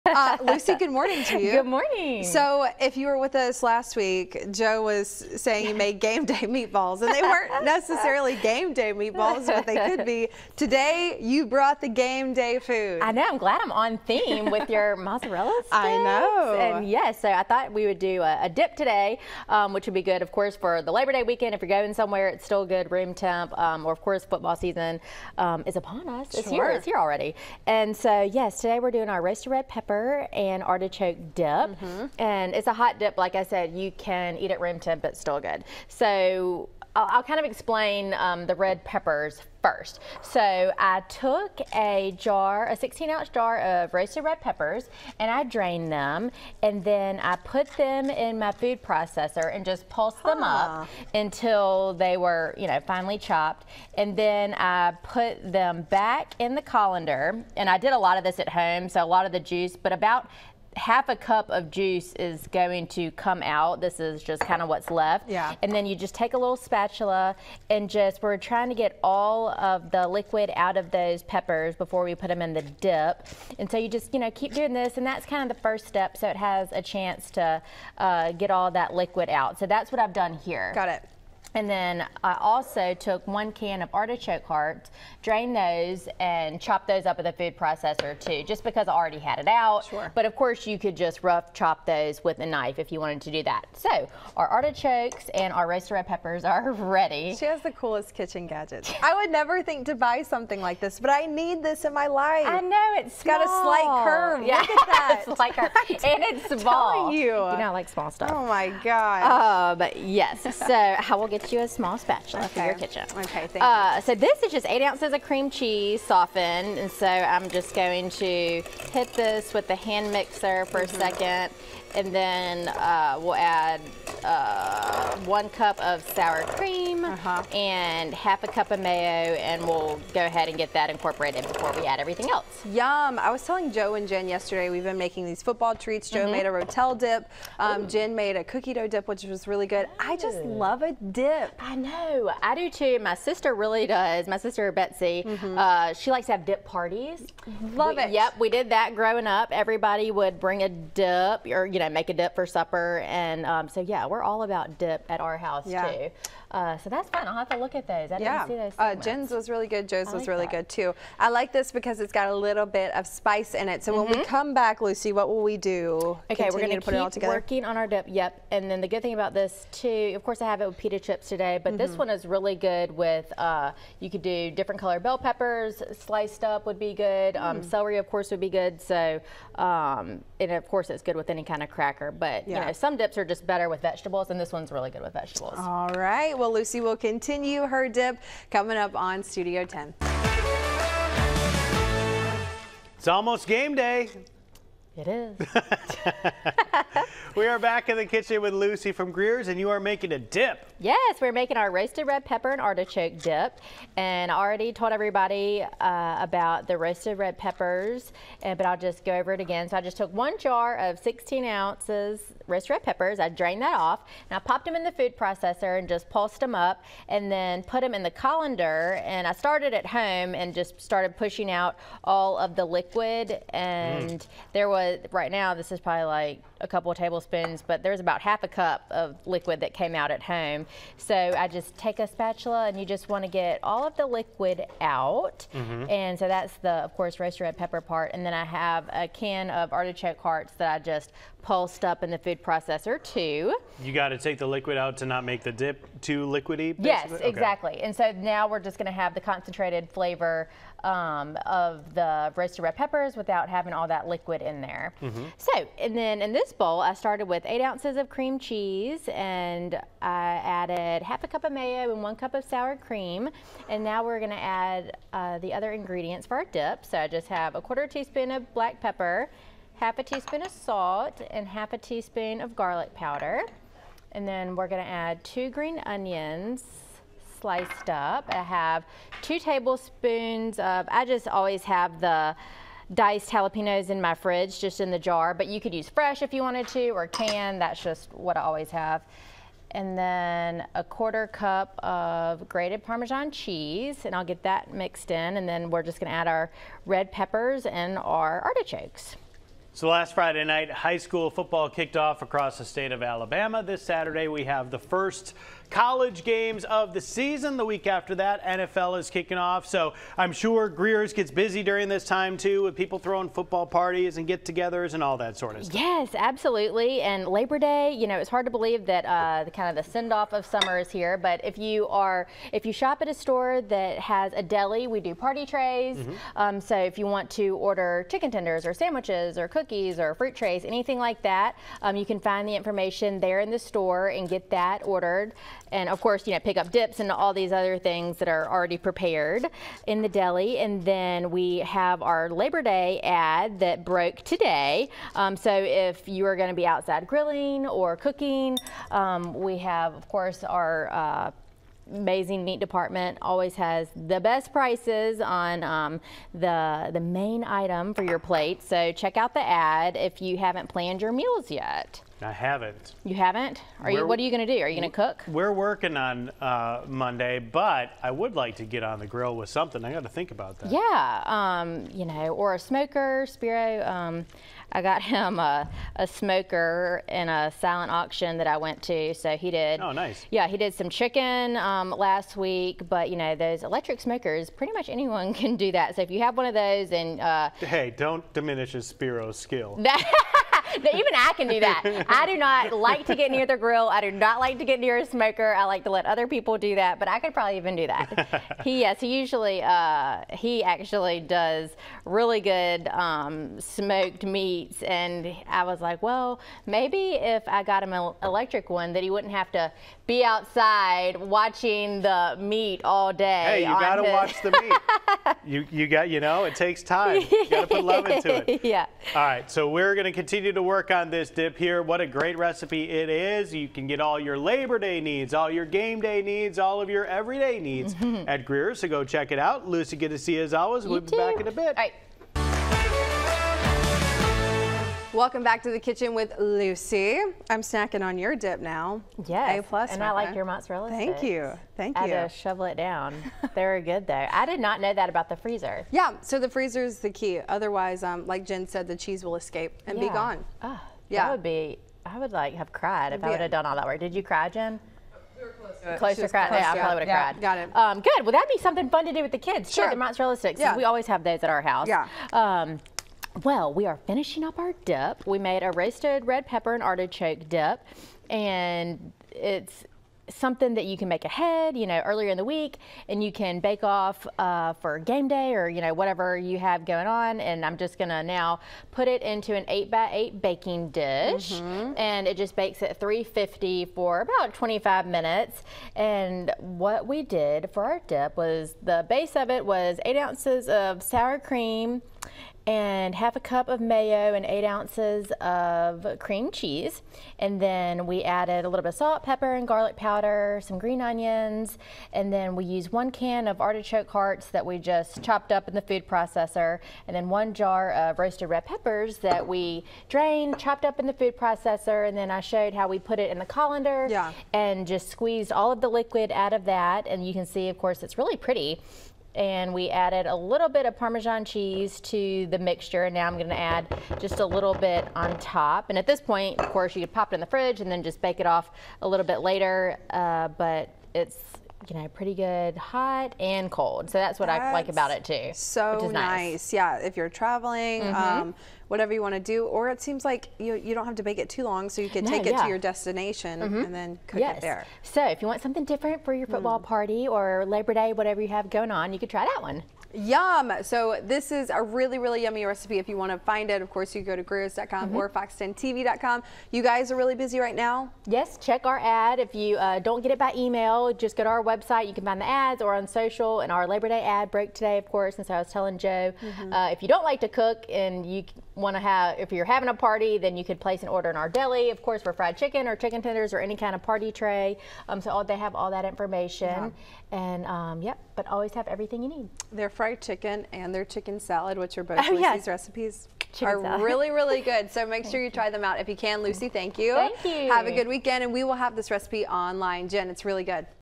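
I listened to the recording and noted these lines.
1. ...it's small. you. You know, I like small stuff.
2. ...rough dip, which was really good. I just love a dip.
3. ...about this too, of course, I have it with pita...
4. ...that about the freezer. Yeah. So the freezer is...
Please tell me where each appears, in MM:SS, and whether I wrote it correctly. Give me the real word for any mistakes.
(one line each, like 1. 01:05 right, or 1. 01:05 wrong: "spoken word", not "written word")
1. 01:46 right
2. 02:18 wrong: "dough", not "rough"
3. 02:49 right
4. 07:24 right.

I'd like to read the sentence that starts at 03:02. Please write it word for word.
you know, some dips are just better with vegetables, and this one's really good with vegetables.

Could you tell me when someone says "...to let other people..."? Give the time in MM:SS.
06:35.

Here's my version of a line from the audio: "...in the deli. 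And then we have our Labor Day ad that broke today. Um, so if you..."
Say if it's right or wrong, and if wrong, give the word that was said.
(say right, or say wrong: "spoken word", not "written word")
right.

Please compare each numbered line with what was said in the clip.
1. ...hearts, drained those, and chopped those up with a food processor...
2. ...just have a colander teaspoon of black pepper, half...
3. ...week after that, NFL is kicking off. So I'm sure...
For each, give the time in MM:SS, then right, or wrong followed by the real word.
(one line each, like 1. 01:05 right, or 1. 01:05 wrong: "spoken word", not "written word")
1. 01:24 right
2. 04:27 wrong: "quarter", not "colander"
3. 05:07 right.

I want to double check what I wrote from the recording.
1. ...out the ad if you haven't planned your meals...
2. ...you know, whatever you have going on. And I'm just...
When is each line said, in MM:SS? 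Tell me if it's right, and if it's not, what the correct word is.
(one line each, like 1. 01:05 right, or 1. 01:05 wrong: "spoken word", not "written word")
1. 05:59 right
2. 07:55 right.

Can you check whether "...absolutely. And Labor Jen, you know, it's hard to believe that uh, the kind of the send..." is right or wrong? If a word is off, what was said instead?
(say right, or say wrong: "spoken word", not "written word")
wrong: "Day", not "Jen".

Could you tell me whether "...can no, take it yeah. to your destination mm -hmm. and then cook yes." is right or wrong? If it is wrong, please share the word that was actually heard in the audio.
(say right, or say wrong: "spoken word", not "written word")
right.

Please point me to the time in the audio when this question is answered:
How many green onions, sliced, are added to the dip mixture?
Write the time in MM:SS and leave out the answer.
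04:35.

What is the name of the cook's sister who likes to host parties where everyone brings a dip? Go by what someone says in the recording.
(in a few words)
Betsy.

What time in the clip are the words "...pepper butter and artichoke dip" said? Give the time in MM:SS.
00:29.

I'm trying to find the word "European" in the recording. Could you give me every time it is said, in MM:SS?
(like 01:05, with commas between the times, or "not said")
not said.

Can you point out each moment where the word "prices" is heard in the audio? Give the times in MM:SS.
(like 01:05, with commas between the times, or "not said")
05:54.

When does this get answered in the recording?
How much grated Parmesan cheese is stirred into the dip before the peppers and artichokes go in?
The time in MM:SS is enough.
04:50.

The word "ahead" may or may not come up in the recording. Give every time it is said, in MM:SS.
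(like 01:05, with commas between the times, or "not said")
02:10, 07:51.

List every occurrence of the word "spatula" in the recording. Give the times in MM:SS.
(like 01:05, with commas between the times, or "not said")
01:06, 01:51, 03:52.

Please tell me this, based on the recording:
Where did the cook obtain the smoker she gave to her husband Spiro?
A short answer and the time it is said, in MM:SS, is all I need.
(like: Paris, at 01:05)
a silent auction, at 06:17.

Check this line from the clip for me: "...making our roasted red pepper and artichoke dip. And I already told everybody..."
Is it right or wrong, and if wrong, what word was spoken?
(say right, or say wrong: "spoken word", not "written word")
right.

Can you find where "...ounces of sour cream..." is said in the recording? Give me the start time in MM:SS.
08:10.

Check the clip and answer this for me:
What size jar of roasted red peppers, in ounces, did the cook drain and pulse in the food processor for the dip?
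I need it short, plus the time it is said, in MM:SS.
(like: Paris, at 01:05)
16 ounce, at 00:42.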